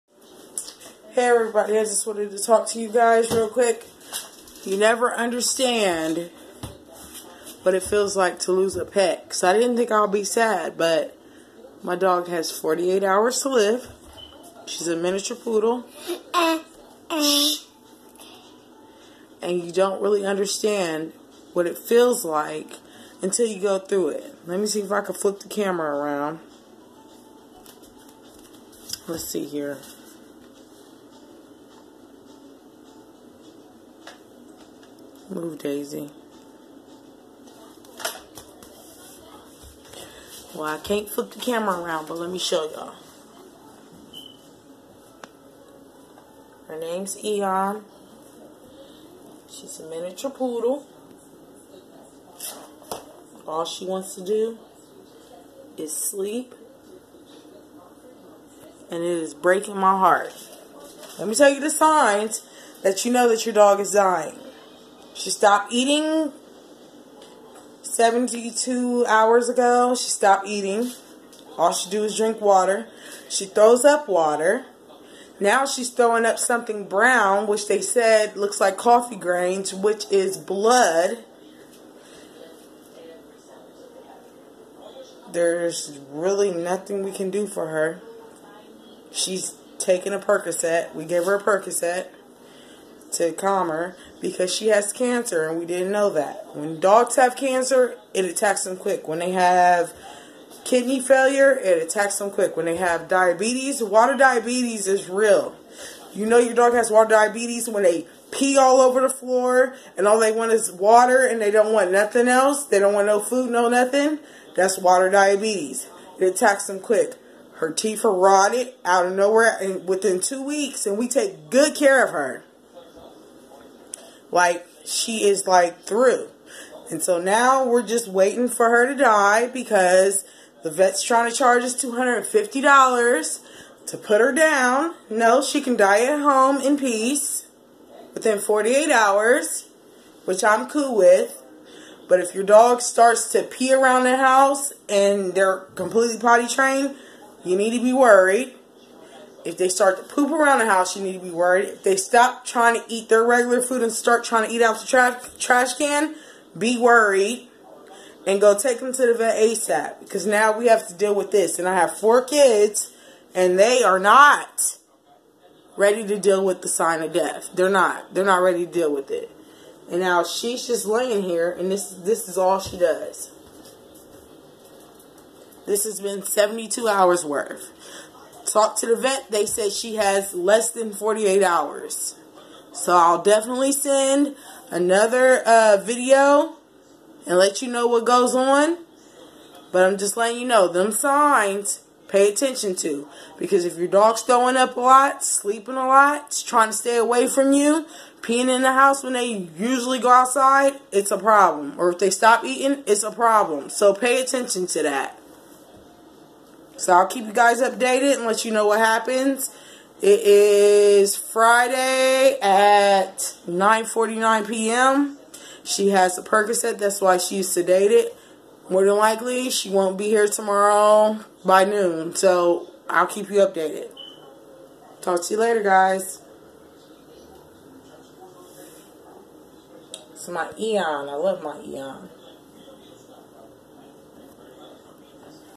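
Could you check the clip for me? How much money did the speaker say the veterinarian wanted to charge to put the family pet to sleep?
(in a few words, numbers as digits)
$250.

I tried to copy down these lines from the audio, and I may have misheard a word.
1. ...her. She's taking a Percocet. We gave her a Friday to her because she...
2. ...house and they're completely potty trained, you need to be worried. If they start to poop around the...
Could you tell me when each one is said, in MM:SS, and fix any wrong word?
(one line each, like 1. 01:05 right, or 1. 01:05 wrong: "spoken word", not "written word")
1. 01:27 wrong: "Percocet", not "Friday"
2. 02:24 right.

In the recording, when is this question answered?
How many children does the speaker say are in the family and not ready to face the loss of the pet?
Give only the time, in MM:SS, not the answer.
02:41.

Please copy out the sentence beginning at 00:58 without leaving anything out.
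And it is breaking my heart.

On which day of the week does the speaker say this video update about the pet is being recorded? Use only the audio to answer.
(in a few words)
Friday.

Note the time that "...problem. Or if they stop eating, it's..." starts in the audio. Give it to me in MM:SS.
03:21.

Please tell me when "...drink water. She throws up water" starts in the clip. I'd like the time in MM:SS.
01:12.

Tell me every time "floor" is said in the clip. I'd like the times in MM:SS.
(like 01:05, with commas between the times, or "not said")
01:49.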